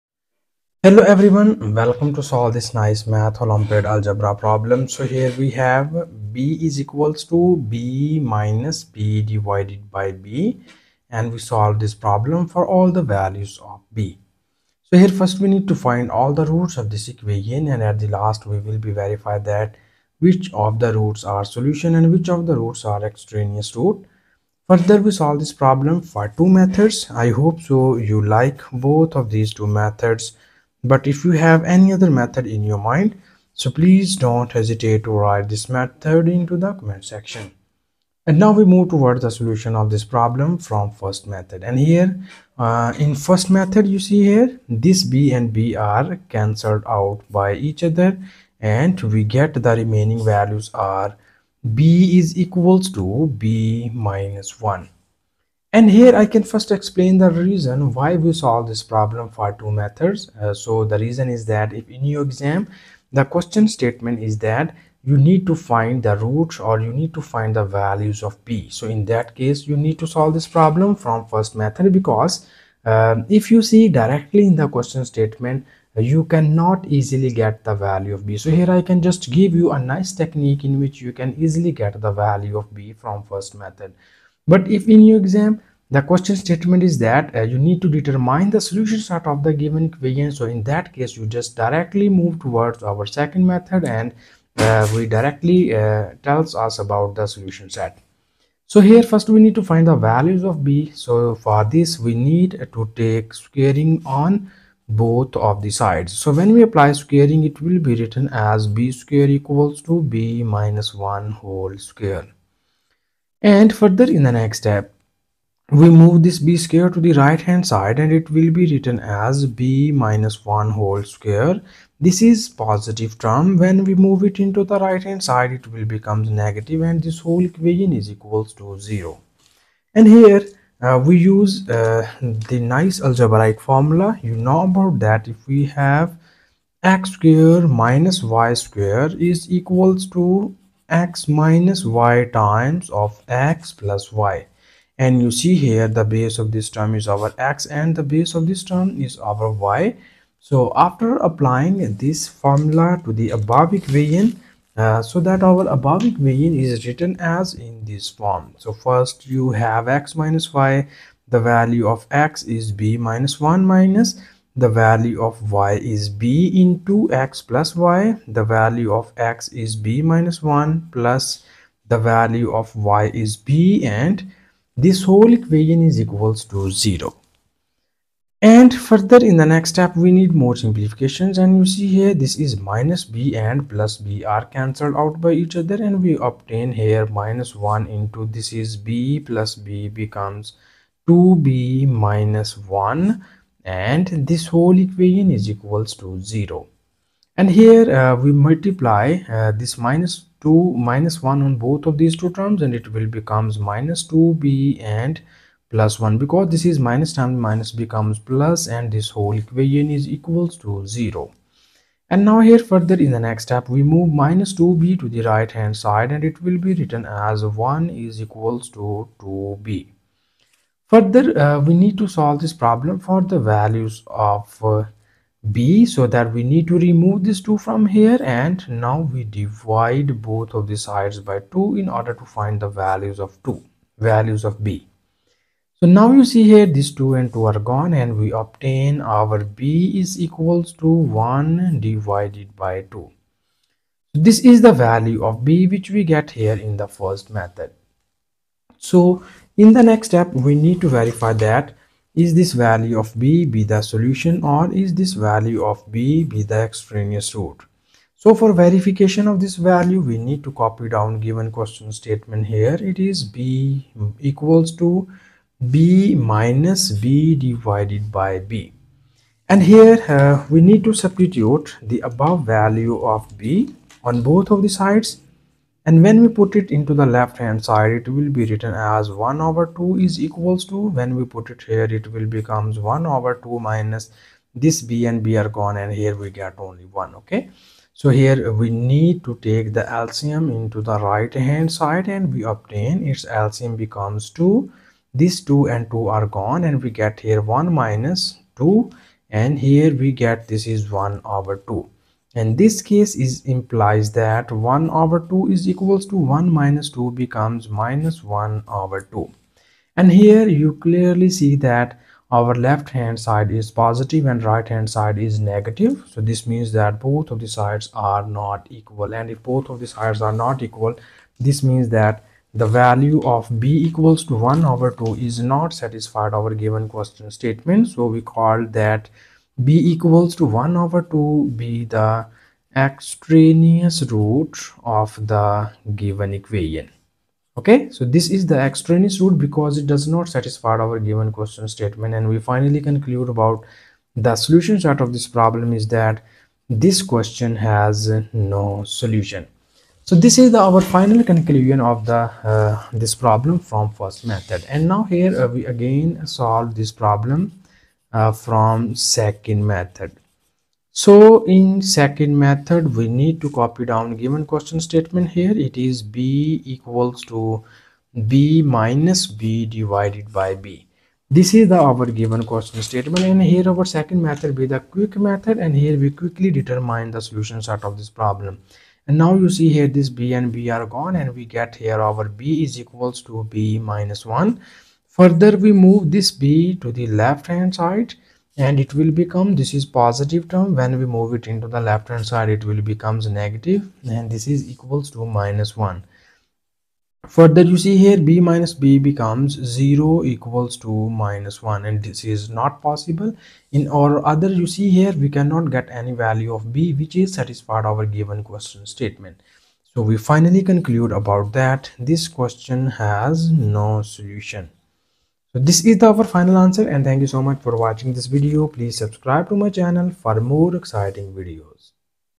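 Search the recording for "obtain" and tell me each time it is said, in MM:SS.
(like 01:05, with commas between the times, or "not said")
03:06, 03:58, 04:52.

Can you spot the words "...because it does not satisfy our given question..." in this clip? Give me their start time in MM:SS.
05:39.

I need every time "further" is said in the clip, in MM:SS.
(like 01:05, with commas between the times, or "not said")
00:24, 01:53, 02:58, 03:32, 03:40, 06:25, 06:37.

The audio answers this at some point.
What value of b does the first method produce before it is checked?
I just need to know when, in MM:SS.
04:01.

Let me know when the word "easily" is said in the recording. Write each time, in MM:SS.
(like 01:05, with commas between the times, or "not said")
01:16, 01:21.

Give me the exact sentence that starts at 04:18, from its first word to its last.
So for verification of this value, we need to copy down given question statement here.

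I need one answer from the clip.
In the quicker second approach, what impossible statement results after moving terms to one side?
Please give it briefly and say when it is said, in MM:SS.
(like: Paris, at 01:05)
0 = -1, at 06:39.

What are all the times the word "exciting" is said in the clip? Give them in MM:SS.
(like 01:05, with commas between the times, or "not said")
07:00.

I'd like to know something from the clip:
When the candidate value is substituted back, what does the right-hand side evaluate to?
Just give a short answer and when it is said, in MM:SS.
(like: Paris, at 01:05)
-1/2, at 05:07.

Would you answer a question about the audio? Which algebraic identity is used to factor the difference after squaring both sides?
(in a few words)
x² - y² = (x - y)(x + y).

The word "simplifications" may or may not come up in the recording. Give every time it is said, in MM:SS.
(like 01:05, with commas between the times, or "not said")
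03:00.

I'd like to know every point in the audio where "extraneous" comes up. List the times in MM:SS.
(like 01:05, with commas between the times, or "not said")
00:23, 04:16, 05:32, 05:38.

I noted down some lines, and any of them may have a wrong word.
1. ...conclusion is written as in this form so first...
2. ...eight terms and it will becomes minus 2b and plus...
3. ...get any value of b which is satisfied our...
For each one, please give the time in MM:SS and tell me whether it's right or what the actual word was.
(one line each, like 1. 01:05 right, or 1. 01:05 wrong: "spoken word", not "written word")
1. 02:36 wrong: "equation", not "conclusion"
2. 03:22 wrong: "two", not "eight"
3. 06:45 right.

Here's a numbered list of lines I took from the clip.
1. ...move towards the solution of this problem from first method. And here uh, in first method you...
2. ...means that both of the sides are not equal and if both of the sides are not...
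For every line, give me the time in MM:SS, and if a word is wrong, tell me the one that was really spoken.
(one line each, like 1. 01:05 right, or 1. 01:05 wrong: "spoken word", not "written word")
1. 00:38 right
2. 05:16 right.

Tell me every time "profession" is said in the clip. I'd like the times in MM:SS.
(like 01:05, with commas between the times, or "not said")
not said.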